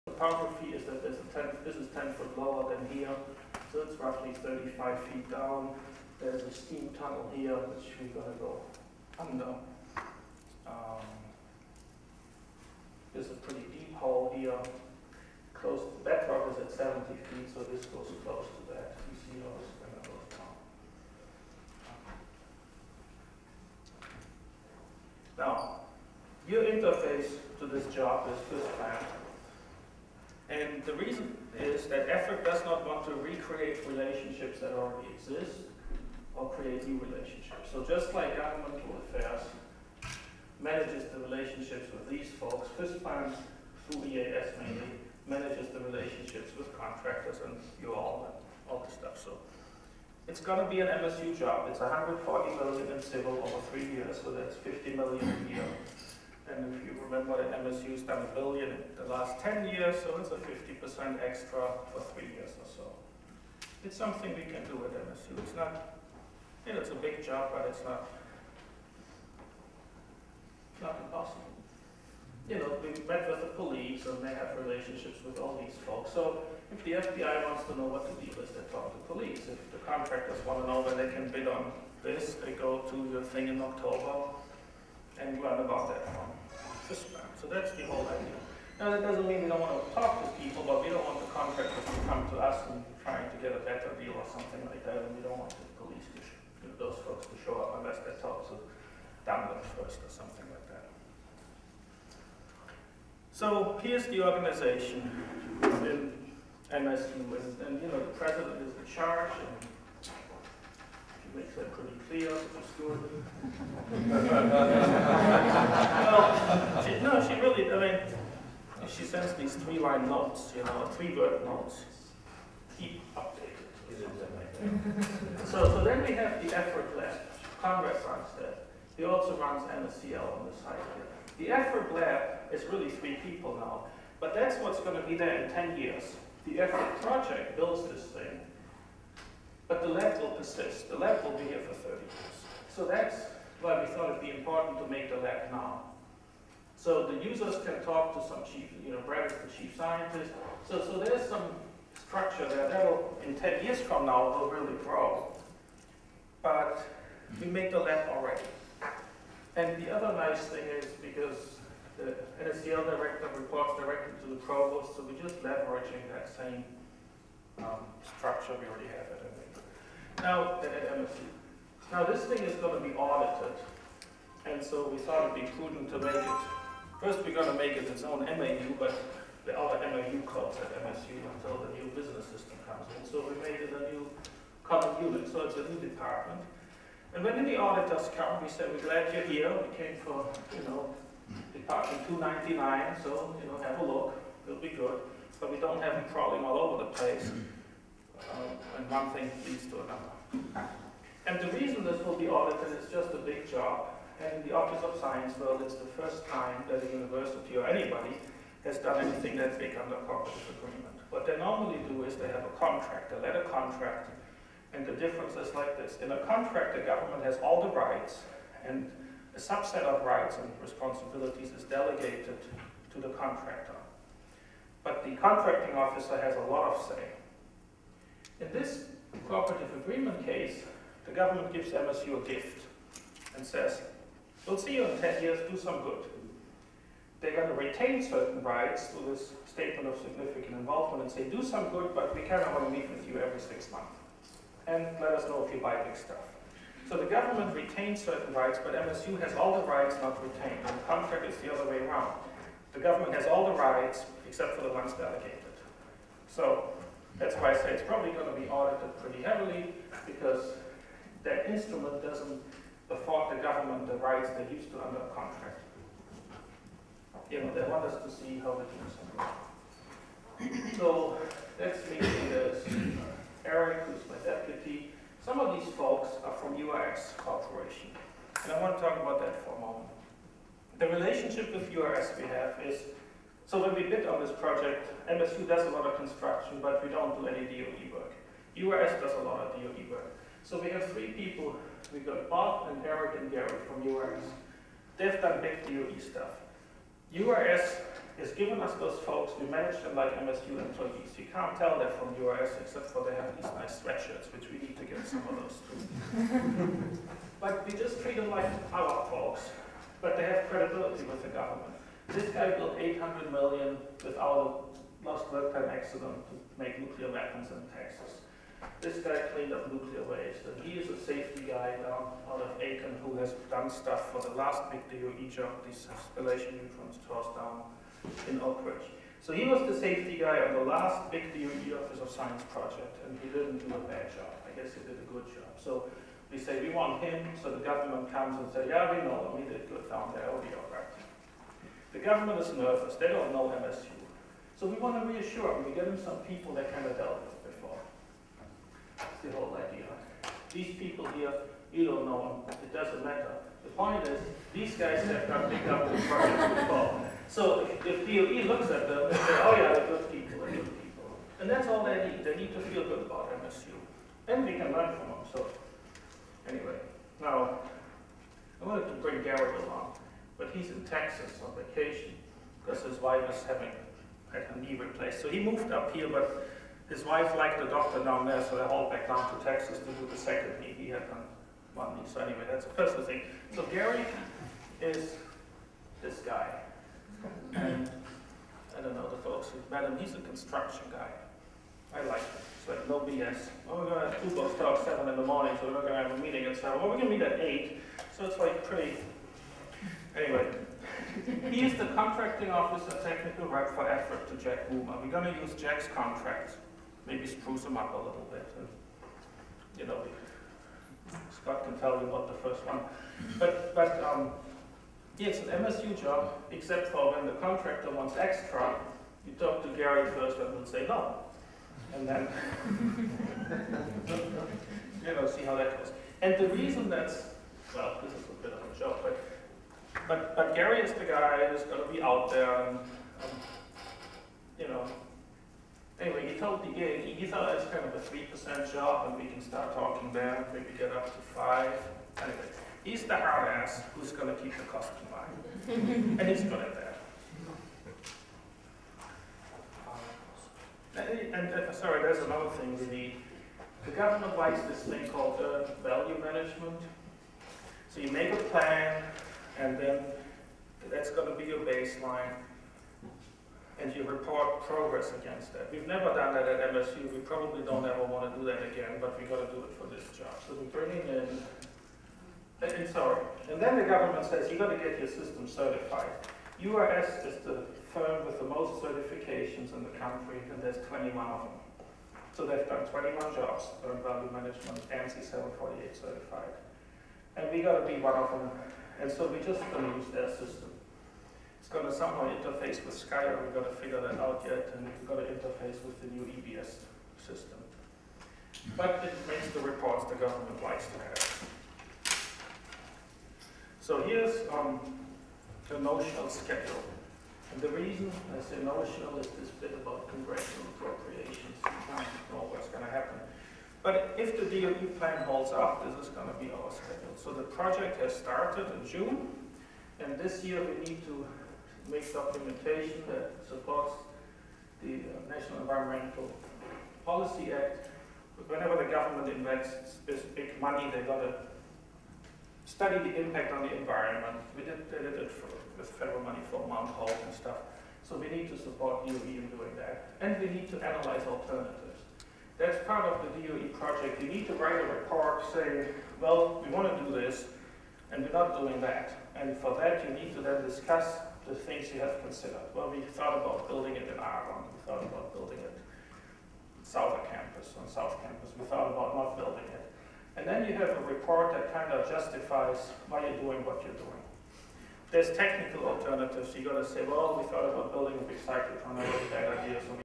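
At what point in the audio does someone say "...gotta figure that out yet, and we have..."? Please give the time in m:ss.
8:13.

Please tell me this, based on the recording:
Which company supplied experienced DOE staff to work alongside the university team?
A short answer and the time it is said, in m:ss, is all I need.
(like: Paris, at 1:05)
URS Corporation, at 4:36.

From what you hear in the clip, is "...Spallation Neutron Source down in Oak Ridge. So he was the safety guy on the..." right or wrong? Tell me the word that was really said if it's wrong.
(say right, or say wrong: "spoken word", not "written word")
right.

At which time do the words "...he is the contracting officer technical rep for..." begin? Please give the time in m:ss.
6:41.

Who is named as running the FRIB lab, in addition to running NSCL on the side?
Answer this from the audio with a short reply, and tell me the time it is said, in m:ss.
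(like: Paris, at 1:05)
Conrad, at 2:07.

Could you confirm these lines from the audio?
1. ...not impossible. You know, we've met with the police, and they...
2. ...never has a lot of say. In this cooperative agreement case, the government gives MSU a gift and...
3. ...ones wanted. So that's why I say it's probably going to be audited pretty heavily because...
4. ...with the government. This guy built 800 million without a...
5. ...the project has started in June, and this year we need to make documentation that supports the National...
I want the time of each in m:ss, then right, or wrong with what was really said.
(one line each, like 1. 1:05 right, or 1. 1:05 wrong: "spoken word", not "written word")
1. 1:10 right
2. 3:45 wrong: "officer", not "never"
3. 4:14 wrong: "delegated", not "wanted"
4. 5:11 right
5. 8:37 right.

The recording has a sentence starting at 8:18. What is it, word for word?
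But it makes the reports the government likes to have.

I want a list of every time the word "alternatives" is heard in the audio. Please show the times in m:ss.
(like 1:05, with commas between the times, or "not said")
9:01, 9:25.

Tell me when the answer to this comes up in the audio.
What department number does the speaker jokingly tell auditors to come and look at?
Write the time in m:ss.
3:12.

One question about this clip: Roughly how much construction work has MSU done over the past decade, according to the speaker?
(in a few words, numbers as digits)
a billion.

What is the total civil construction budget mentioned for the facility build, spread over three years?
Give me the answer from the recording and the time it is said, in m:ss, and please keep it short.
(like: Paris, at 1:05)
140 million, at 0:51.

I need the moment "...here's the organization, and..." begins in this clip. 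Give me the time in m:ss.
1:43.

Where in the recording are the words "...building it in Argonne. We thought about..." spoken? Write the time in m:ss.
9:13.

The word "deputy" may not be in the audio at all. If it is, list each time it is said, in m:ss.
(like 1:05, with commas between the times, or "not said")
4:34.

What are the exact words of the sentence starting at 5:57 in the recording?
So if, if DOE looks at them and say, oh yeah, they're good people, they're good people.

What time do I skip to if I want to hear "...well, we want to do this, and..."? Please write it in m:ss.
9:06.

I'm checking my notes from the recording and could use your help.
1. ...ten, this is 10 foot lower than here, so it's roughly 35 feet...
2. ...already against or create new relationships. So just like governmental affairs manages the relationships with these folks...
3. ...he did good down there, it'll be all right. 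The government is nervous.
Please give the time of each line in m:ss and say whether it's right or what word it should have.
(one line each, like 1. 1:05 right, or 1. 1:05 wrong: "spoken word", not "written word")
1. 0:01 right
2. 0:34 wrong: "exist", not "against"
3. 5:39 right.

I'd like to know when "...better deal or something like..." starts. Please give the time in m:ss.
1:33.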